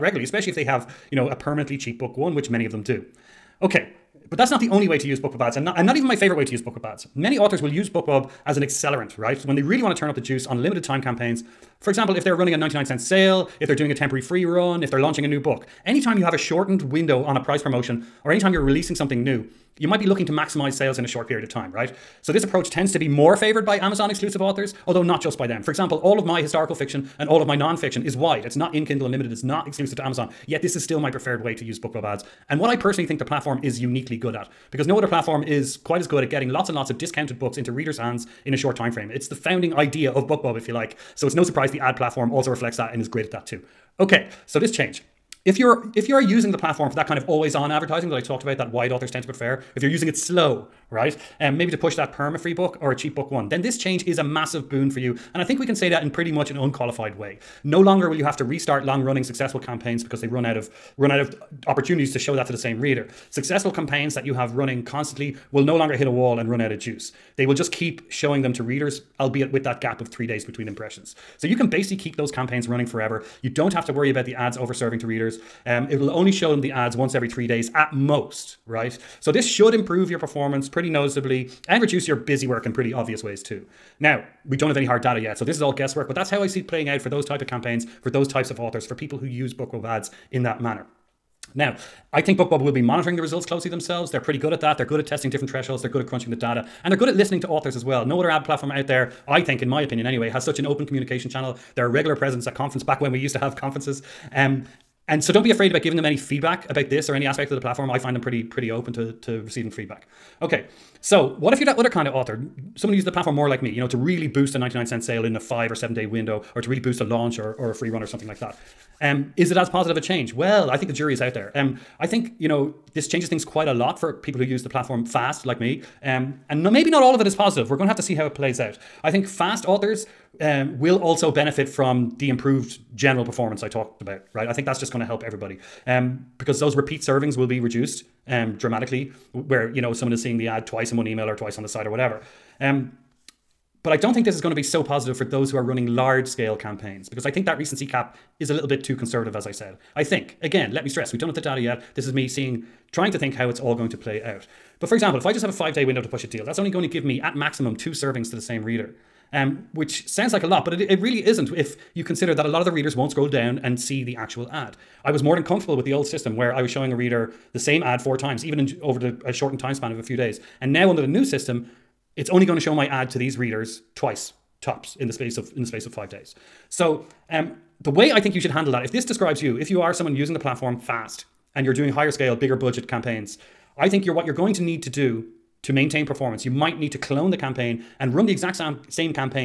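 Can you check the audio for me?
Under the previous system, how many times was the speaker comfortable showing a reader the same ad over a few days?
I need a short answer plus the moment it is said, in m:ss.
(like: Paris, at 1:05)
4, at 2:47.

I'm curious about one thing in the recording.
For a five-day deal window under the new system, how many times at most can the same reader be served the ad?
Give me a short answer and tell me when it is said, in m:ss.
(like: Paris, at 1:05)
2, at 2:37.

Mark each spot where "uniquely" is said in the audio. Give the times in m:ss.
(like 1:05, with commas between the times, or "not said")
0:33.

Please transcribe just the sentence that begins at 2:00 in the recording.
Well, I think the jury is out there.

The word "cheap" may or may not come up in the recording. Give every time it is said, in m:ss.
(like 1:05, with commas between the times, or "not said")
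0:01, 0:52.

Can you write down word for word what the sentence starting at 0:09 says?
When they really want to turn up the juice on limited time campaigns.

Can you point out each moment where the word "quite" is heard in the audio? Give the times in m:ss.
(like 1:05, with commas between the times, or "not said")
0:35, 2:03.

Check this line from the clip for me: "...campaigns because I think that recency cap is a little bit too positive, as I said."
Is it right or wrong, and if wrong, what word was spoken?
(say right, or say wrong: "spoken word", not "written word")
wrong: "conservative", not "positive".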